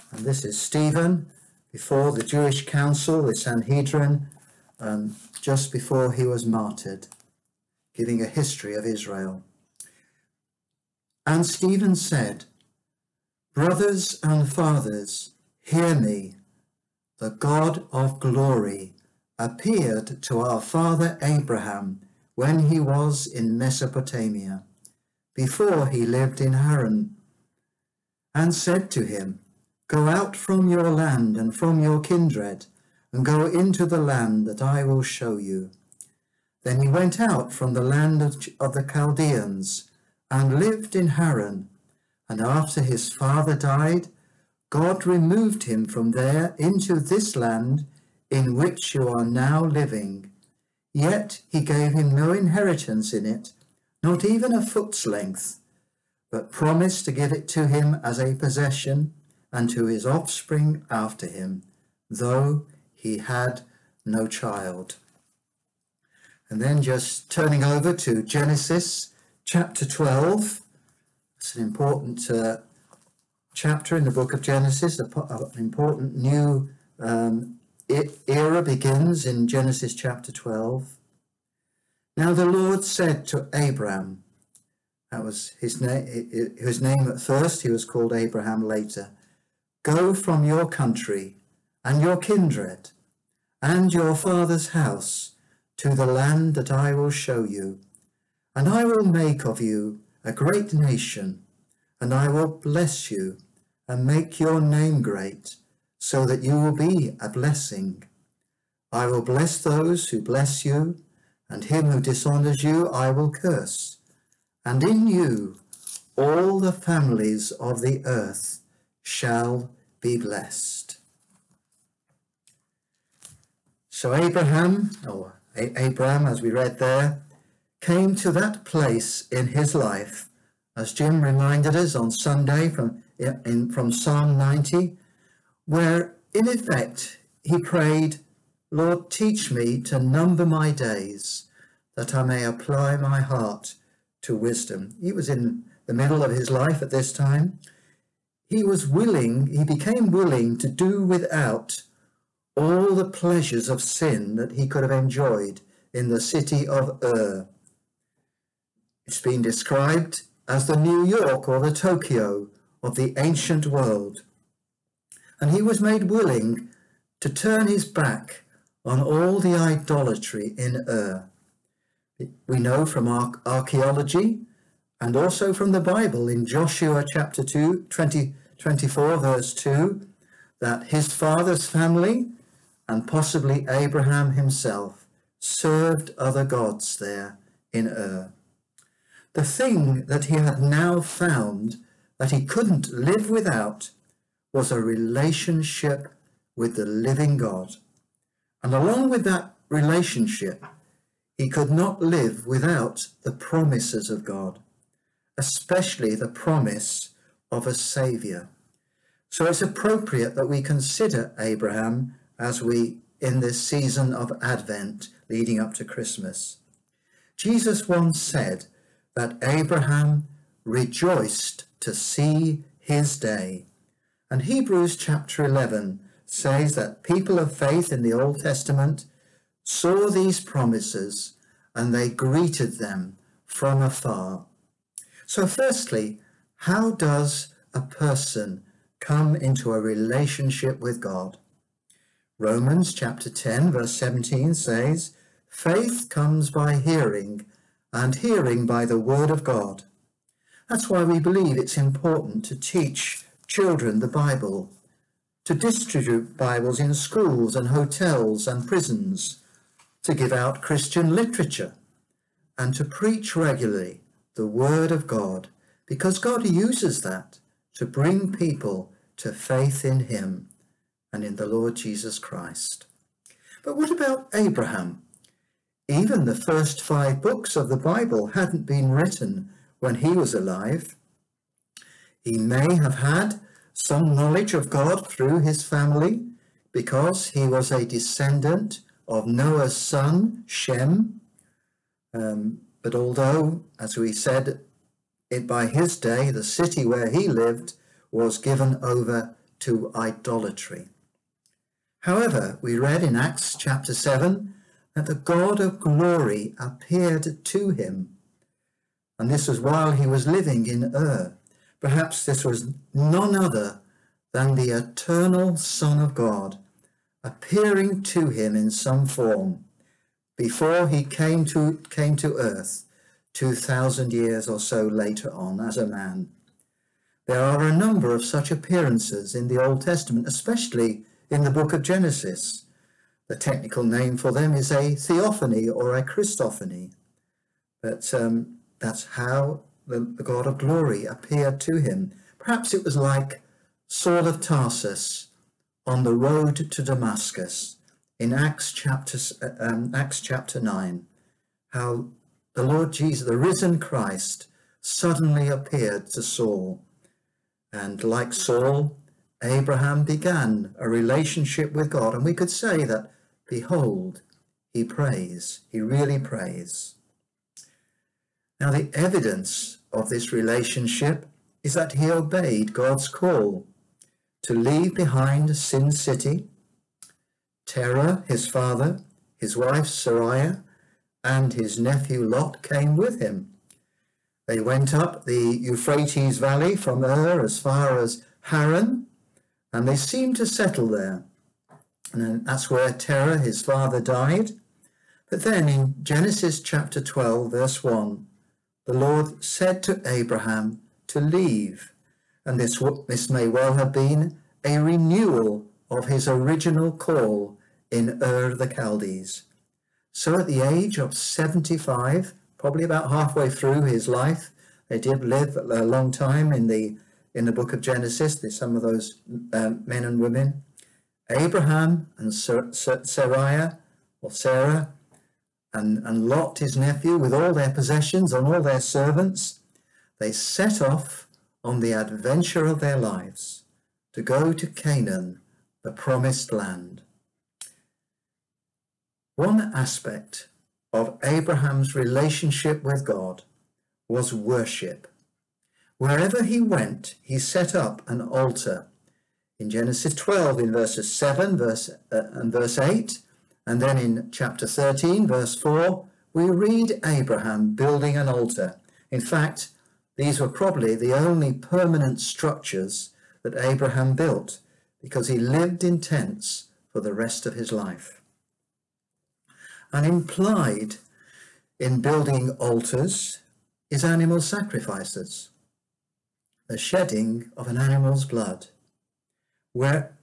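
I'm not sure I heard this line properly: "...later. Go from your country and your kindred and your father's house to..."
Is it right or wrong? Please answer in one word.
right.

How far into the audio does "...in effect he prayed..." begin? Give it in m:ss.
2:16.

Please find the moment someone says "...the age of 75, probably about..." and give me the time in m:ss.
6:50.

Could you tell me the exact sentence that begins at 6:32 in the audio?
And that's where Terah, his father, died.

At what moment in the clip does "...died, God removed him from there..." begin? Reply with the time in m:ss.
0:43.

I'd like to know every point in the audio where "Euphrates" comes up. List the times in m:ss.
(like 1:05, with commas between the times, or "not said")
6:25.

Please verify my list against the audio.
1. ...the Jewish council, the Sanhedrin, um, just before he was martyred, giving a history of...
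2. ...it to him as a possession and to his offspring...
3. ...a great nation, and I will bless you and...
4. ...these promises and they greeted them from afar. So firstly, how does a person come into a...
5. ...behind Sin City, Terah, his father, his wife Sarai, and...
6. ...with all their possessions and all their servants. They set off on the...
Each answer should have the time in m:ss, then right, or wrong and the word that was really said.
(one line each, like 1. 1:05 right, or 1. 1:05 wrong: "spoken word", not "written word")
1. 0:02 right
2. 0:57 right
3. 1:40 right
4. 3:50 right
5. 6:14 right
6. 7:07 right.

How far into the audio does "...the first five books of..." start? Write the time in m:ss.
4:36.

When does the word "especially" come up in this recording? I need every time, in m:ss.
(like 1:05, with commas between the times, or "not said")
3:25, 5:30.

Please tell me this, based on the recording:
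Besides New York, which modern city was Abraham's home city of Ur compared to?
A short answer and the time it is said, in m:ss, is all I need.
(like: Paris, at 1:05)
Tokyo, at 2:41.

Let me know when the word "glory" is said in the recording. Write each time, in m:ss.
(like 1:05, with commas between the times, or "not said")
0:18, 5:05, 5:40.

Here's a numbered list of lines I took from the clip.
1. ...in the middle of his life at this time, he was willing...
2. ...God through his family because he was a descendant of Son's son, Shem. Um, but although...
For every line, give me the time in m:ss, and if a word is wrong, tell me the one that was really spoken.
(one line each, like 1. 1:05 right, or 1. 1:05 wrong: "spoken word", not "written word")
1. 2:25 right
2. 4:44 wrong: "Noah", not "Son".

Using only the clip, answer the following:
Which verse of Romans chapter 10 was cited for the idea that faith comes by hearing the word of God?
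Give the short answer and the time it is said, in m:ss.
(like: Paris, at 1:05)
Verse 17, at 4:03.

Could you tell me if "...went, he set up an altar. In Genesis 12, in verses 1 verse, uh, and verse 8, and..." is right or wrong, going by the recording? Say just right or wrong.
wrong.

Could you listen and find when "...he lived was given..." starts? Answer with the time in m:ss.
4:57.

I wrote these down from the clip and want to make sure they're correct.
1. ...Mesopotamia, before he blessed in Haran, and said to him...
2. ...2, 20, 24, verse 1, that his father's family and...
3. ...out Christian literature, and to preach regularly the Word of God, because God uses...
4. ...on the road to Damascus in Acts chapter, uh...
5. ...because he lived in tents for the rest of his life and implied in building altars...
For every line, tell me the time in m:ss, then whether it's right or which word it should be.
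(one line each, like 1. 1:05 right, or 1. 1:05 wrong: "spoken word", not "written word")
1. 0:23 wrong: "lived", not "blessed"
2. 2:57 wrong: "2", not "1"
3. 4:20 right
4. 5:45 right
5. 7:45 right.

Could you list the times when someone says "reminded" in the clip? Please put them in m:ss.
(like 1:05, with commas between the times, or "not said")
2:11.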